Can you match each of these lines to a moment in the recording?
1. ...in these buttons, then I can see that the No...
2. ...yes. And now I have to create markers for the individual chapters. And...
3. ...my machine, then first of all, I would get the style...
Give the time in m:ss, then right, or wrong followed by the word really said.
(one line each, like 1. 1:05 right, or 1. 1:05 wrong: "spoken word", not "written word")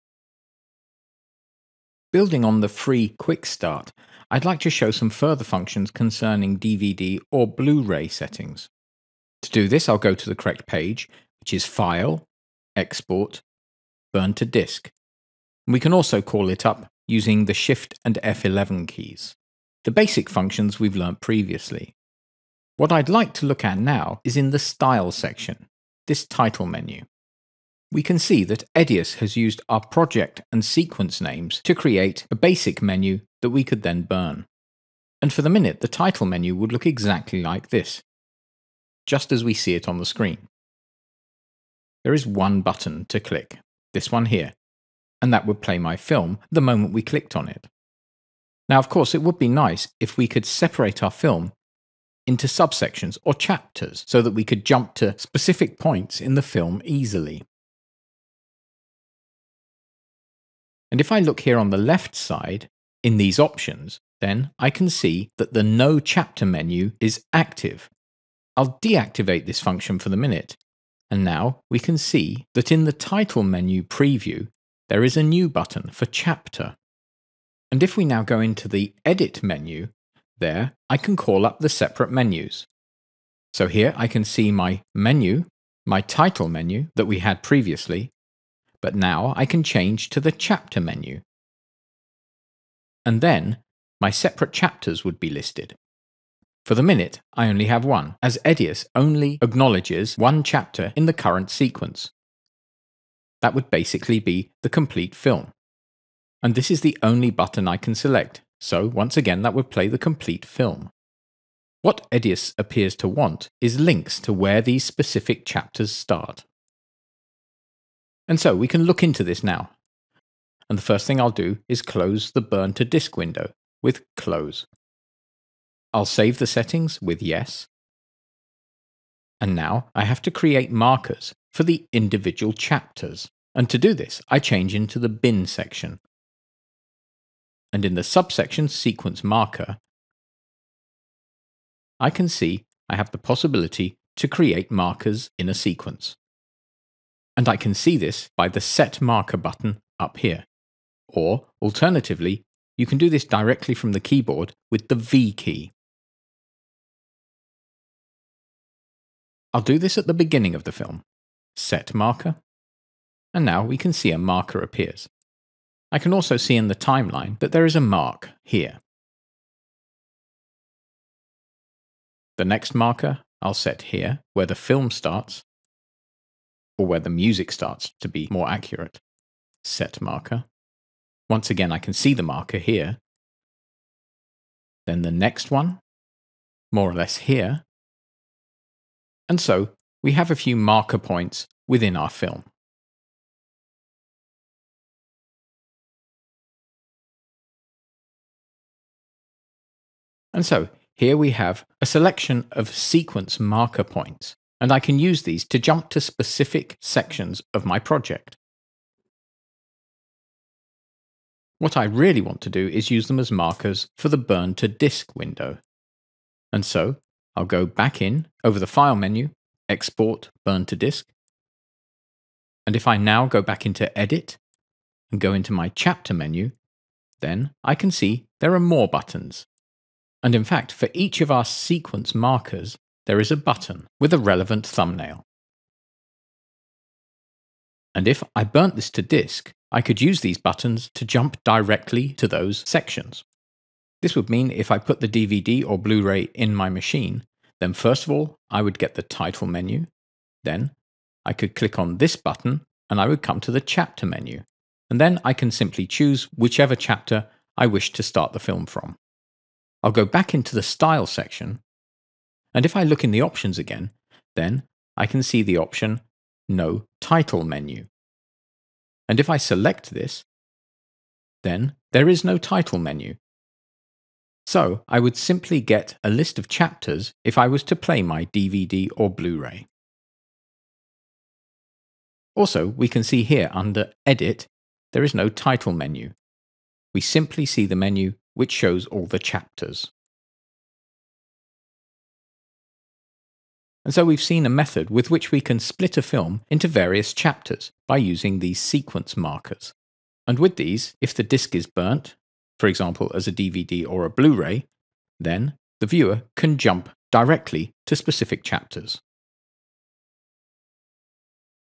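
1. 1:03 wrong: "options", not "buttons"
2. 2:07 right
3. 4:06 wrong: "title", not "style".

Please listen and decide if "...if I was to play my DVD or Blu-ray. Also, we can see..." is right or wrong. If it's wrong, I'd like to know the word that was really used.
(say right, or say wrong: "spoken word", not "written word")
right.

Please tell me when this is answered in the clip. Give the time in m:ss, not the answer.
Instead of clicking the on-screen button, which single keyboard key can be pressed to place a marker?
2:34.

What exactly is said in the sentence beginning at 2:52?
The next marker I'll set here, where the film starts, or where the music starts to be more accurate.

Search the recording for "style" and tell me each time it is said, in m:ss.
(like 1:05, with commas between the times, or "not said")
0:24, 4:20.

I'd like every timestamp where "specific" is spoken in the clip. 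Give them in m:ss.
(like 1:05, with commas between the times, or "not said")
0:55, 1:54, 3:25, 5:07.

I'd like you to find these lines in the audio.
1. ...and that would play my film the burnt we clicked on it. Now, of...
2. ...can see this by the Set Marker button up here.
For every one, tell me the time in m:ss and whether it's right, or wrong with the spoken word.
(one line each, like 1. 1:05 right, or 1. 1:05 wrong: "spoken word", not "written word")
1. 0:45 wrong: "moment", not "burnt"
2. 2:27 right.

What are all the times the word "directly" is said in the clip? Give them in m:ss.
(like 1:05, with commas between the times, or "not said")
2:33, 4:01, 5:07.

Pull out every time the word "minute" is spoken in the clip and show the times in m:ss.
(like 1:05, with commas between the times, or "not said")
0:35, 1:10, 1:36.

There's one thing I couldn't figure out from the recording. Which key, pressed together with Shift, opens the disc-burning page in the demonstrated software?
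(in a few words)
F11.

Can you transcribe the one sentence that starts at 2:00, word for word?
And the first thing I'll do is close the burn to disk window with close.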